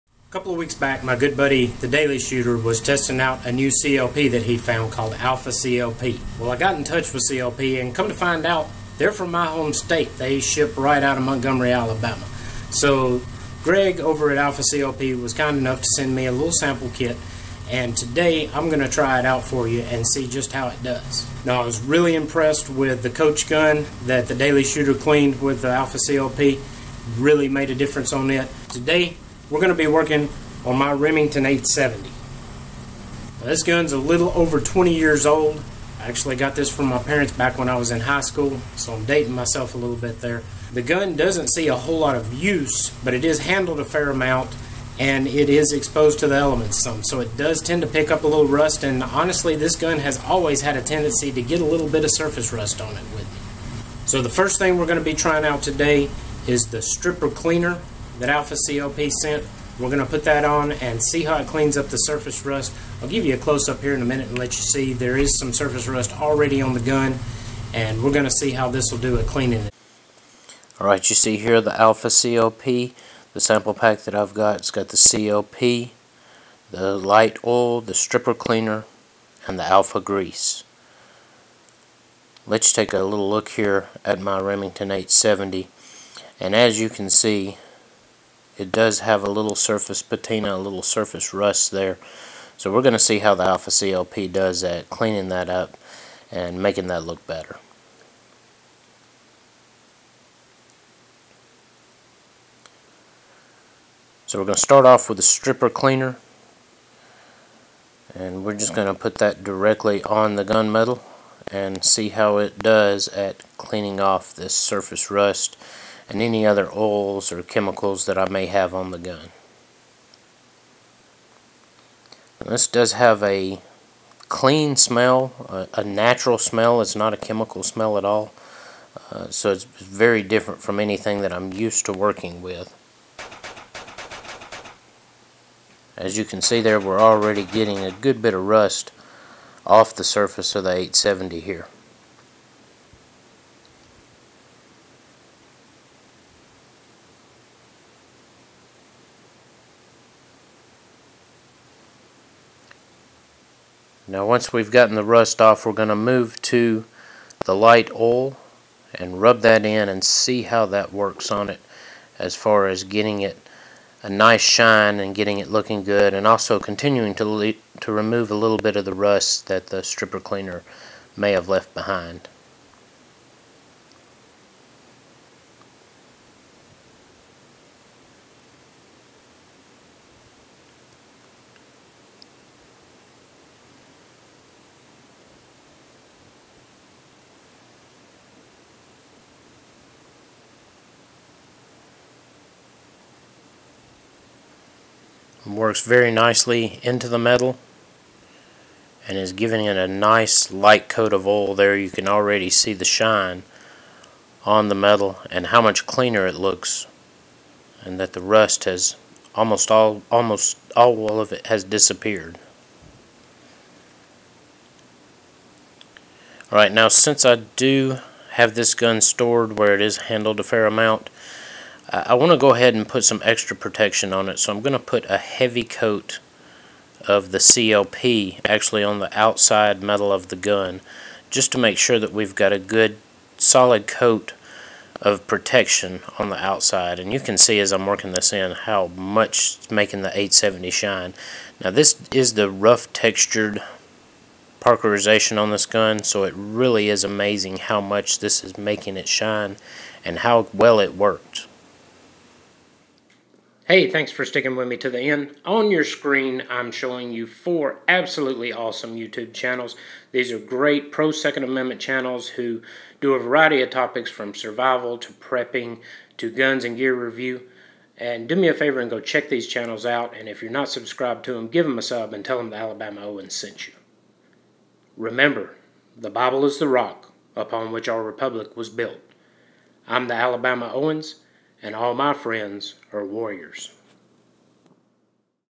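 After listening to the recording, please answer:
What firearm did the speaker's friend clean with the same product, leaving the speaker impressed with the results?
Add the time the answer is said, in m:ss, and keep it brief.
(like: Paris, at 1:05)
coach gun, at 0:23.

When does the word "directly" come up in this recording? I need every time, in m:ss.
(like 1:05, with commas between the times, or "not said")
1:49.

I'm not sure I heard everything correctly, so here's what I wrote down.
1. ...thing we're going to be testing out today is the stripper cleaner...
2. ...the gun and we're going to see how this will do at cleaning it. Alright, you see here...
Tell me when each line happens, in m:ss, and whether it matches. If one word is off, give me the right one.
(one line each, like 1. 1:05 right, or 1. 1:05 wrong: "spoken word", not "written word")
1. 0:54 wrong: "trying", not "testing"
2. 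1:06 right.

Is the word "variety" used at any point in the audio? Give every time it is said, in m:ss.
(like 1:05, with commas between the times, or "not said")
4:23.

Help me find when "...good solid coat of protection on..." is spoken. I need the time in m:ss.
3:52.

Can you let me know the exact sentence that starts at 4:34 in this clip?
Remember, the Bible is the rock upon which our republic was built.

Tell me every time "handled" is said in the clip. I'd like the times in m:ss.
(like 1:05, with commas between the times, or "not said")
0:43, 3:39.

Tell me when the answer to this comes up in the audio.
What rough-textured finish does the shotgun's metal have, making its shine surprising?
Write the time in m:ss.
4:04.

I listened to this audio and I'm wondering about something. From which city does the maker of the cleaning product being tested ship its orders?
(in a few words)
Montgomery, Alabama.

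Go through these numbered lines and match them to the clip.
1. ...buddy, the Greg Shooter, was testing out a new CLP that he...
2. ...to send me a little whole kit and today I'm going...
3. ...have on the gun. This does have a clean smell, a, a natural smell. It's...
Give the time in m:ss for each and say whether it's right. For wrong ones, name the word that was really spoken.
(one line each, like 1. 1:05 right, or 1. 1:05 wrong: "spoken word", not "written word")
1. 0:01 wrong: "Daily", not "Greg"
2. 0:15 wrong: "sample", not "whole"
3. 1:58 right.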